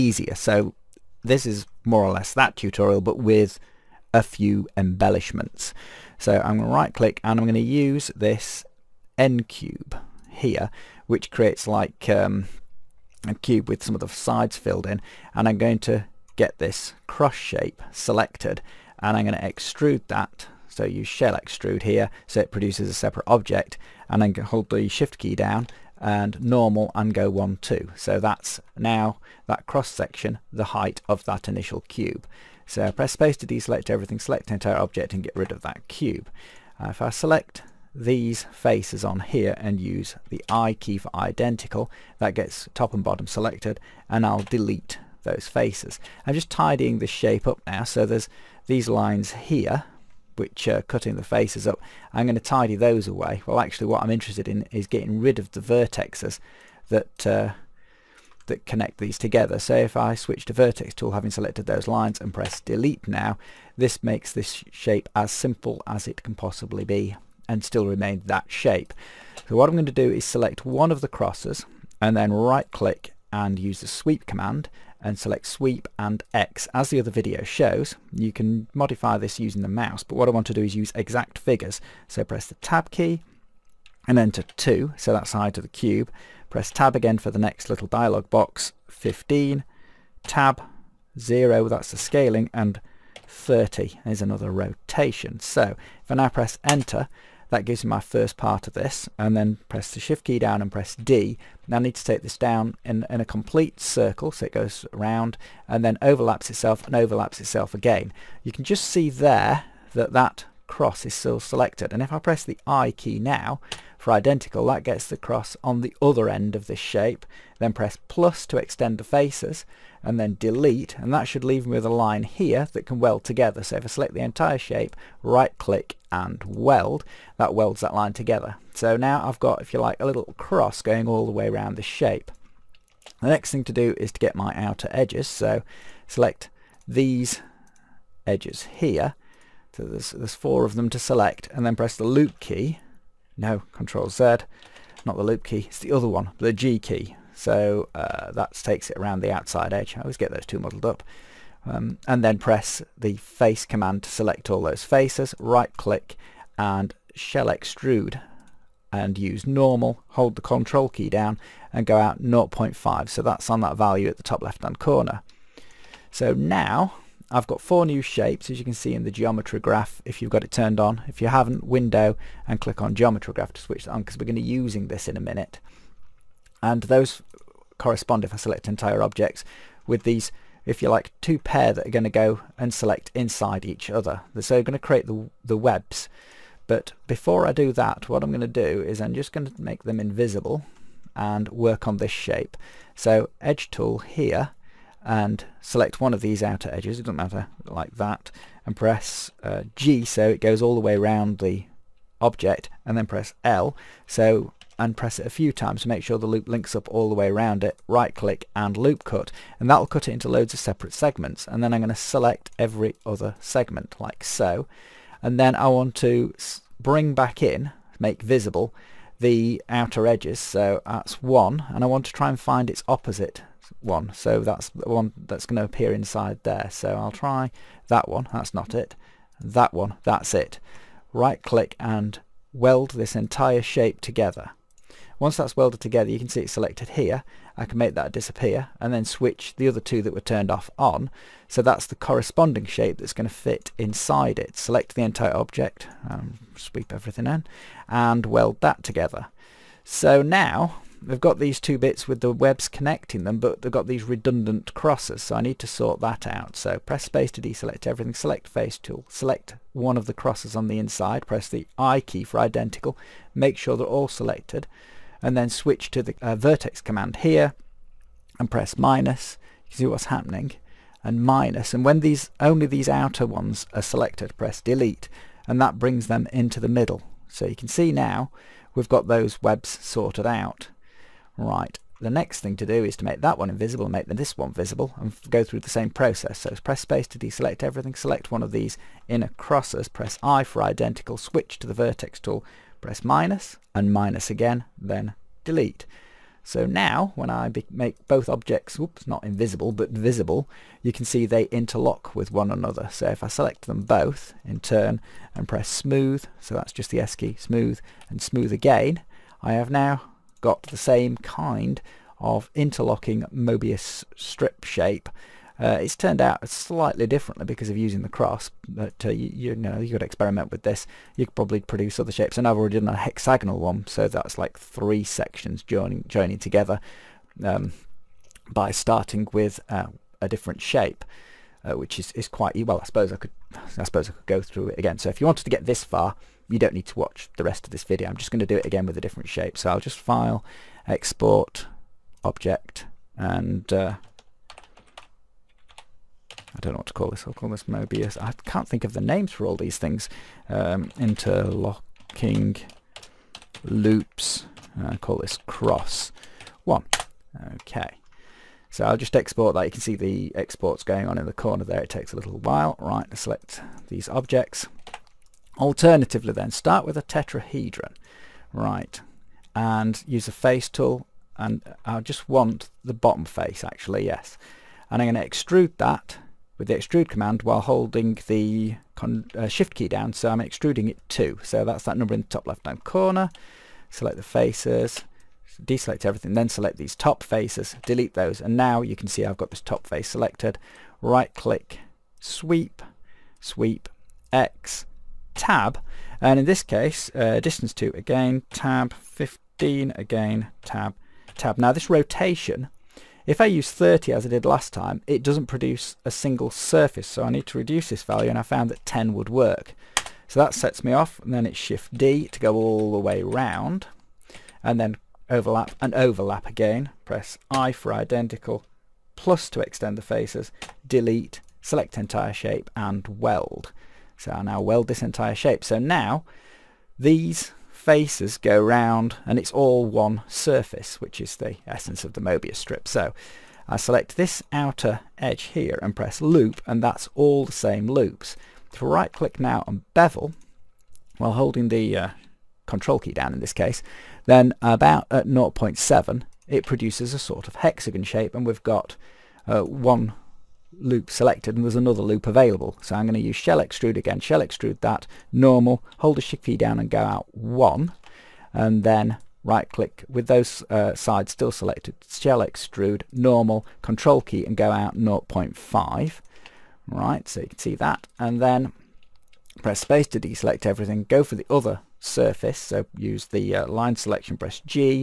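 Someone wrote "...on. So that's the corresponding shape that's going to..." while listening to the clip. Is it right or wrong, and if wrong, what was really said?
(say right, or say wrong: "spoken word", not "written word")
right.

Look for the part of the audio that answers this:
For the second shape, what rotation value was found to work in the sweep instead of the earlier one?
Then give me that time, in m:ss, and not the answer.
6:48.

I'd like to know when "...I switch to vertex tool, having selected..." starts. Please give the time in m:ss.
0:59.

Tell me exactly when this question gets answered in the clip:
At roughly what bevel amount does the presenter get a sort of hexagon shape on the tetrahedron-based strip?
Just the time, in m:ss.
7:25.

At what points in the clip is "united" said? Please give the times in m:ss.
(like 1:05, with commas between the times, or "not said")
not said.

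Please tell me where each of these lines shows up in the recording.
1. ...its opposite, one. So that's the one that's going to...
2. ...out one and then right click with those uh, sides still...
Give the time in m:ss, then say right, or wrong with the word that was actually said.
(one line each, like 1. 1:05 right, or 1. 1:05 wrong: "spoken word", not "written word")
1. 3:42 right
2. 7:36 right.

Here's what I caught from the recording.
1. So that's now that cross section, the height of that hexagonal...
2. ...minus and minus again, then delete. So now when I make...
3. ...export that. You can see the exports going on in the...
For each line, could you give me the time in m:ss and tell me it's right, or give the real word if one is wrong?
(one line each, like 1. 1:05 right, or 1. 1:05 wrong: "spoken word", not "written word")
1. 0:27 wrong: "initial", not "hexagonal"
2. 4:53 right
3. 5:59 right.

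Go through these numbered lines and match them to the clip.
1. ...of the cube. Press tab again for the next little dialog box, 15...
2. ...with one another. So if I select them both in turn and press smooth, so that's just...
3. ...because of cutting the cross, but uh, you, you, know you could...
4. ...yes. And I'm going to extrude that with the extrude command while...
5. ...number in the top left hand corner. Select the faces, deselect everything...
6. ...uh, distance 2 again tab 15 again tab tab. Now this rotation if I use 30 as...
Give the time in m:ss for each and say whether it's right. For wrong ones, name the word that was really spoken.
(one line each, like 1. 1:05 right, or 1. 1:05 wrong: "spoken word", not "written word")
1. 1:25 right
2. 5:02 right
3. 5:17 wrong: "using", not "cutting"
4. 6:14 right
5. 6:21 right
6. 6:37 right.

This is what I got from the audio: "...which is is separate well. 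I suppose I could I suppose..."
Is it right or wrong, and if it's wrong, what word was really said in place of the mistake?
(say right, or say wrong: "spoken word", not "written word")
wrong: "quite", not "separate".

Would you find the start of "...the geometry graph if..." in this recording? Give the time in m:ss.
2:49.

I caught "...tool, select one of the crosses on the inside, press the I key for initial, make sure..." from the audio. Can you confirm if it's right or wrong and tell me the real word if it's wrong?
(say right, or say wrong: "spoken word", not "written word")
wrong: "identical", not "initial".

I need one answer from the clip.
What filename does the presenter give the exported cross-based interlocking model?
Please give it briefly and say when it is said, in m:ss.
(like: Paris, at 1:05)
cross one, at 5:55.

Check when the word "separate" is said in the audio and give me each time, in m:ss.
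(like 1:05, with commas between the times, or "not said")
0:22, 3:30.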